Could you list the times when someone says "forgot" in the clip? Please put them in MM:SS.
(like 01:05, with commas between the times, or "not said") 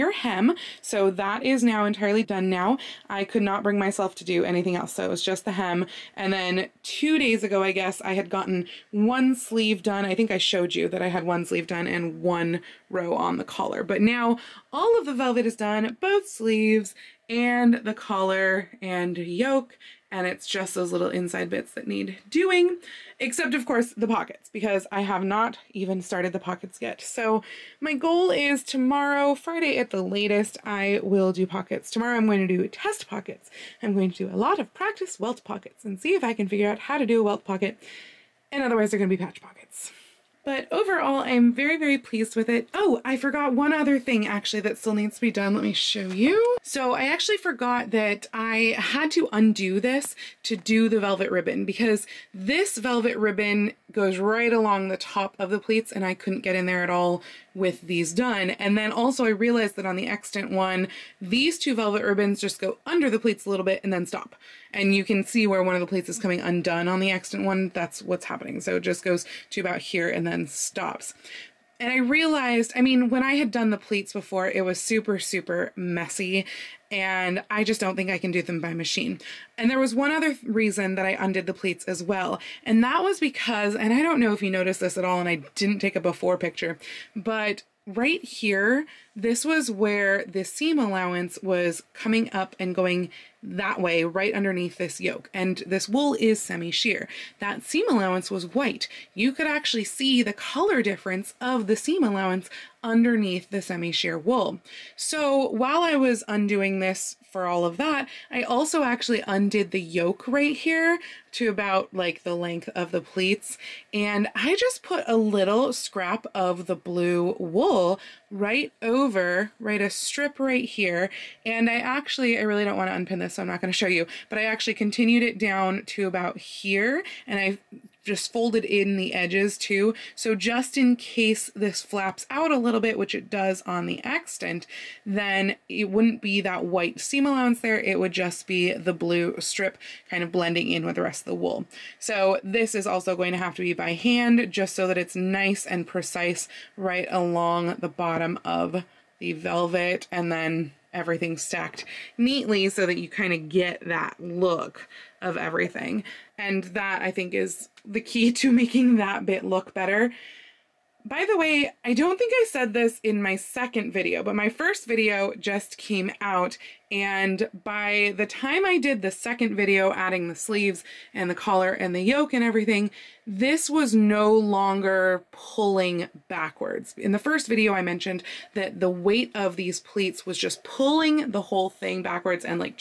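00:43, 00:47.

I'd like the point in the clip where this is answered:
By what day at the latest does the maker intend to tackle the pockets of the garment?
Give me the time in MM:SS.
00:29.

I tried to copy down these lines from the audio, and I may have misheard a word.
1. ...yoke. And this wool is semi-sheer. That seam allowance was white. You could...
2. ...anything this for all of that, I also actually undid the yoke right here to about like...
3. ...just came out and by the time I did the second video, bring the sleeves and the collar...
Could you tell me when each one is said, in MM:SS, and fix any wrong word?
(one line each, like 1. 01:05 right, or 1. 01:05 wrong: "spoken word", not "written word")
1. 01:35 right
2. 01:46 wrong: "undoing", not "anything"
3. 02:45 wrong: "adding", not "bring".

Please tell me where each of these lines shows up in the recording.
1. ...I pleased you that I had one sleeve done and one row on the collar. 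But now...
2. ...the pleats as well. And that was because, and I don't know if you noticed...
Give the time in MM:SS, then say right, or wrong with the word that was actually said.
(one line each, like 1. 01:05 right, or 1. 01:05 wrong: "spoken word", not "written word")
1. 00:10 wrong: "showed", not "pleased"
2. 01:21 right.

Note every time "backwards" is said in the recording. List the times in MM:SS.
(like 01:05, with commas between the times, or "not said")
02:56, 03:02.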